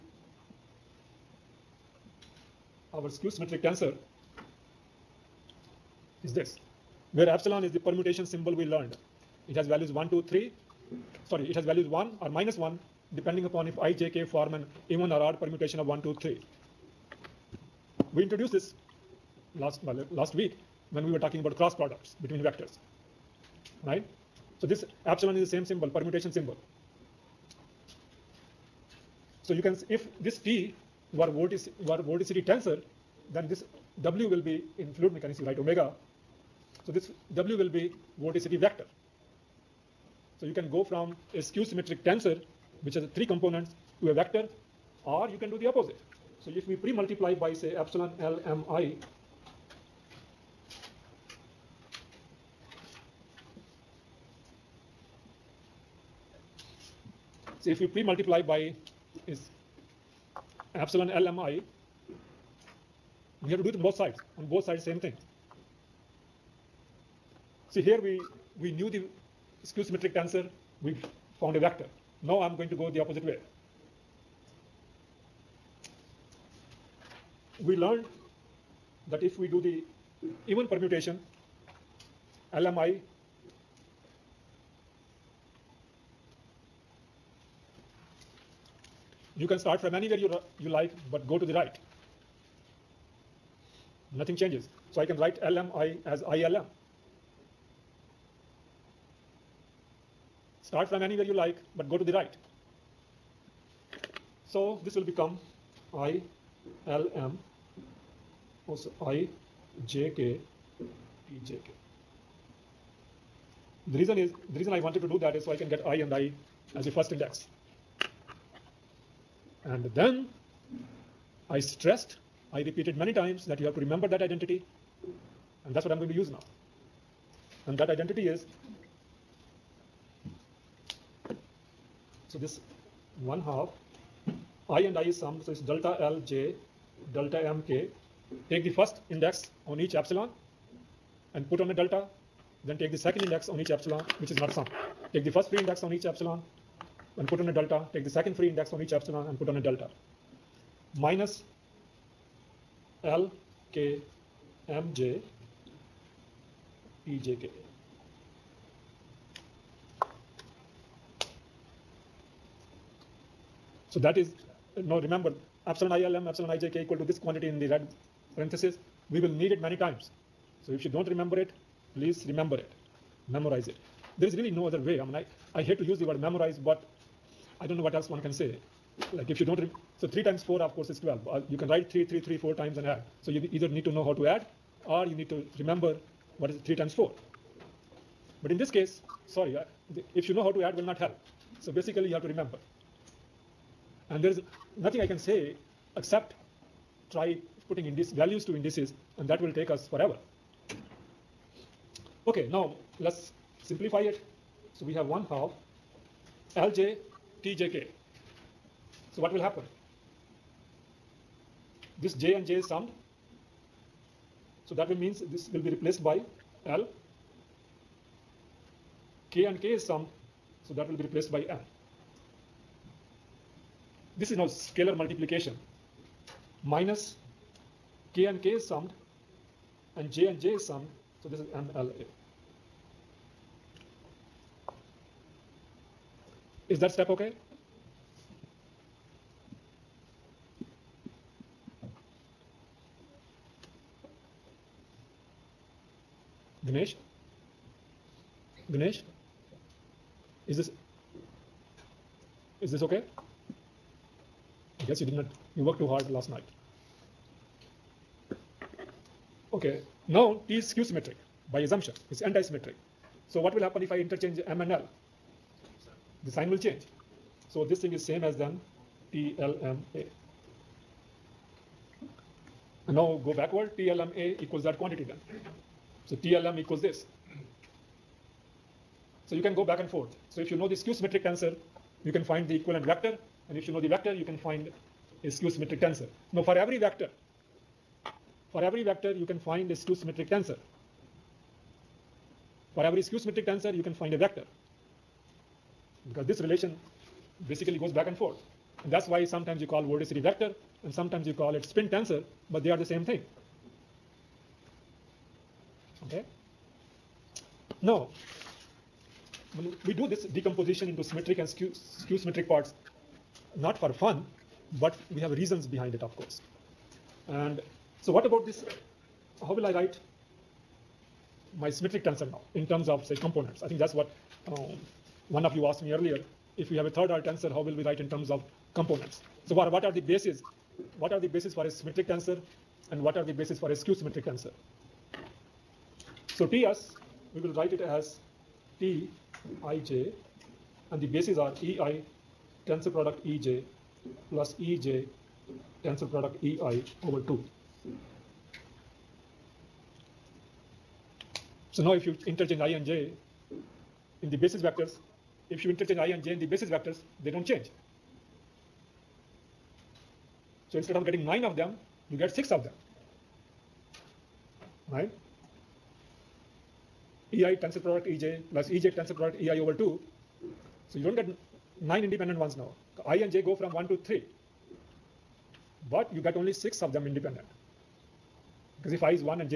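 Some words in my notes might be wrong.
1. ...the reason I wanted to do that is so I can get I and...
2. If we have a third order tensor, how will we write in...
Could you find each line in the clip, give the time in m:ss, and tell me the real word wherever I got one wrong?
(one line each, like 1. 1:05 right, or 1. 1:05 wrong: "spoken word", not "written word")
1. 1:54 right
2. 5:26 right.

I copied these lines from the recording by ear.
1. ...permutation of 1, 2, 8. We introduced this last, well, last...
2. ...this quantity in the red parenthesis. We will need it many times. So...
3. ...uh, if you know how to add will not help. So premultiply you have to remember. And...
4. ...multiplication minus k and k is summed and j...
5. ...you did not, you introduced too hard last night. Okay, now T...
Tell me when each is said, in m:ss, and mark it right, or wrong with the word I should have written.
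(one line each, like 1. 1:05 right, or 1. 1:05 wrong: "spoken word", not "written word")
1. 0:15 wrong: "3", not "8"
2. 2:47 right
3. 3:09 wrong: "basically", not "premultiply"
4. 3:44 right
5. 4:14 wrong: "worked", not "introduced".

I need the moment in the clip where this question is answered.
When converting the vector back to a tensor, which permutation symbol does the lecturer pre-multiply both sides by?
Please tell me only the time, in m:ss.
1:00.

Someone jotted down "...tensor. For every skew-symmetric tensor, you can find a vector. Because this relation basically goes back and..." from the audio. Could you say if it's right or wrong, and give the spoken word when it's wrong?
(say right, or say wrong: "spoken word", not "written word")
right.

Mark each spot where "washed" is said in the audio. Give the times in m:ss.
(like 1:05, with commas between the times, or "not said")
not said.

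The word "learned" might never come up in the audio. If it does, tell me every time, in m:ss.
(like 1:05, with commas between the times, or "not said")
0:08, 1:17.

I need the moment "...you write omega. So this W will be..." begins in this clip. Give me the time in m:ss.
0:35.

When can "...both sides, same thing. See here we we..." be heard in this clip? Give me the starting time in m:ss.
1:04.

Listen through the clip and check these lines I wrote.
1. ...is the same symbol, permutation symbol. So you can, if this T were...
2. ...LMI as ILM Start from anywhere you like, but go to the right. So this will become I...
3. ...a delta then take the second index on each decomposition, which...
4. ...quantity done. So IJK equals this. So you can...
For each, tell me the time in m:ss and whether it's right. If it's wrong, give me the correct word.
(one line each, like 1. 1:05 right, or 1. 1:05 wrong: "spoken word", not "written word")
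1. 0:25 right
2. 1:35 right
3. 2:21 wrong: "epsilon", not "decomposition"
4. 4:34 wrong: "TLM", not "IJK".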